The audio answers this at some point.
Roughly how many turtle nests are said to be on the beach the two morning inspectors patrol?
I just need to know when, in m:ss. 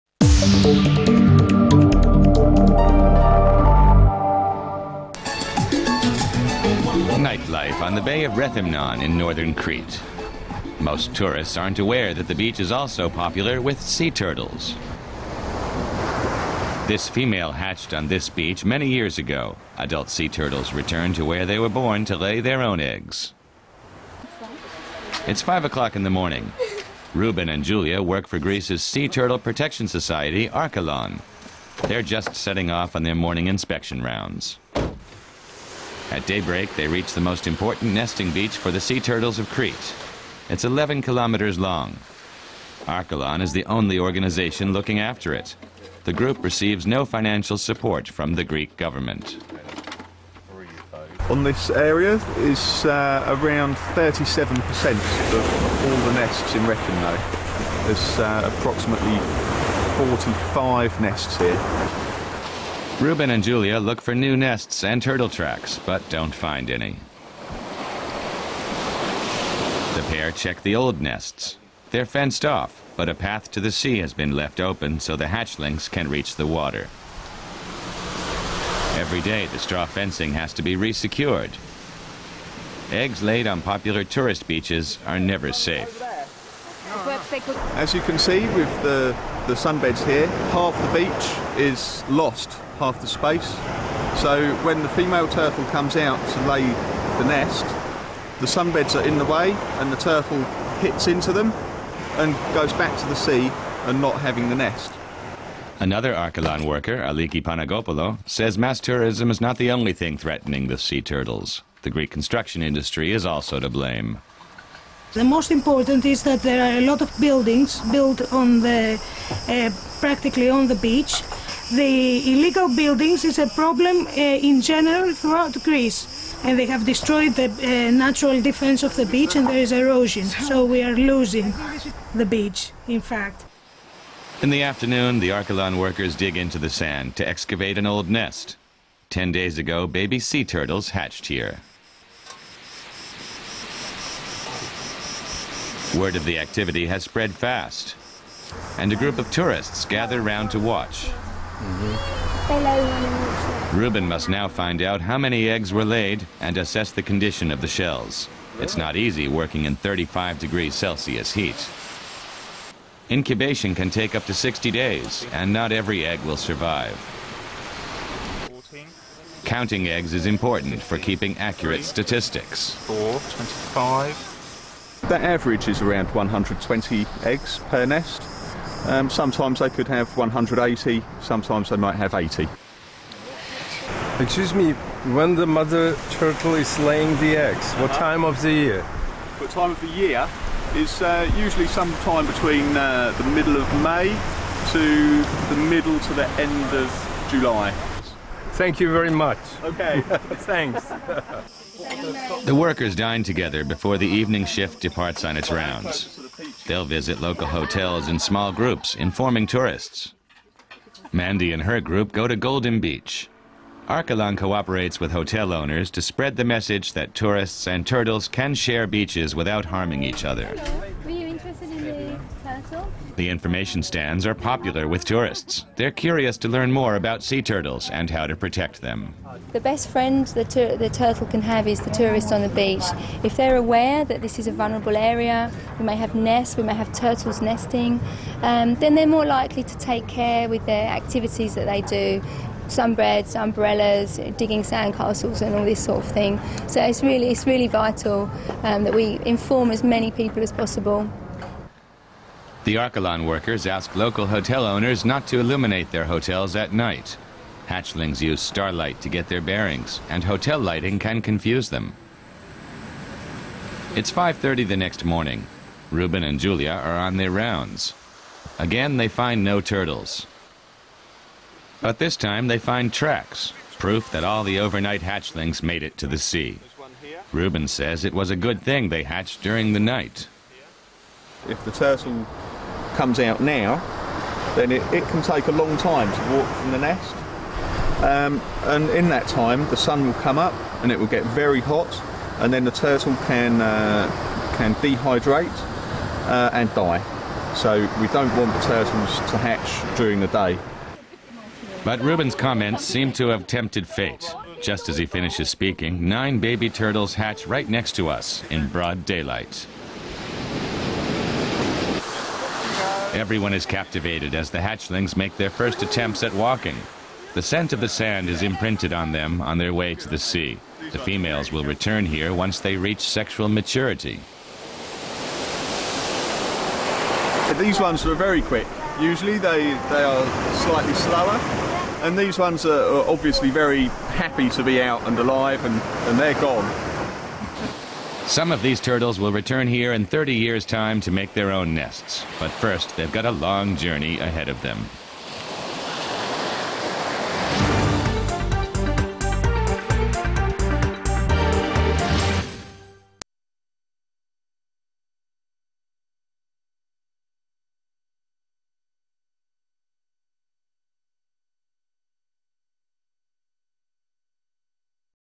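0:58.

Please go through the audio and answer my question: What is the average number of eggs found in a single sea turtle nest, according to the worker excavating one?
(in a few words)
120.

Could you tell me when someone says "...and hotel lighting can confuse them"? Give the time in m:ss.
4:20.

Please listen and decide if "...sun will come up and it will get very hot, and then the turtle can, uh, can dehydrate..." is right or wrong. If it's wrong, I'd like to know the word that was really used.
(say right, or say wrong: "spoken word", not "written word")
right.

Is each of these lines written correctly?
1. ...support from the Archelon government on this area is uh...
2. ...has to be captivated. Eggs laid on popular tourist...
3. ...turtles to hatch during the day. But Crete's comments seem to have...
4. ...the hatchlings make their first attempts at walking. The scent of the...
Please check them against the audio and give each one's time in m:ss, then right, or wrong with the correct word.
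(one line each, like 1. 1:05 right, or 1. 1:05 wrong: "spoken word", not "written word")
1. 0:47 wrong: "Greek", not "Archelon"
2. 1:20 wrong: "resecured", not "captivated"
3. 4:58 wrong: "Ruben", not "Crete"
4. 5:14 right.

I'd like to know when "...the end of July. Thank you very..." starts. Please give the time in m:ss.
3:16.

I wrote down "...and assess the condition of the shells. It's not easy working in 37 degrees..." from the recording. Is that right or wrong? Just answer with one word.
wrong.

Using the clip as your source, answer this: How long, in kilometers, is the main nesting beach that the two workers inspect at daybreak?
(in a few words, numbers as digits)
11 kilometers.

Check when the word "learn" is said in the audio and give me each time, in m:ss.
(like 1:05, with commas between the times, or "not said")
3:46.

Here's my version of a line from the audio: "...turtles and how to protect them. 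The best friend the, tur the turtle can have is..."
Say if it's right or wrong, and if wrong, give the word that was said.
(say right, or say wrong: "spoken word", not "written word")
right.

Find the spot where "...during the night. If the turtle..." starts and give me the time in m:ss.
4:39.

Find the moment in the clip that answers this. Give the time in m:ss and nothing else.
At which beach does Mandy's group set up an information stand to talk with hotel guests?
3:32.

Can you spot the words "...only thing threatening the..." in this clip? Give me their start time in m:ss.
1:49.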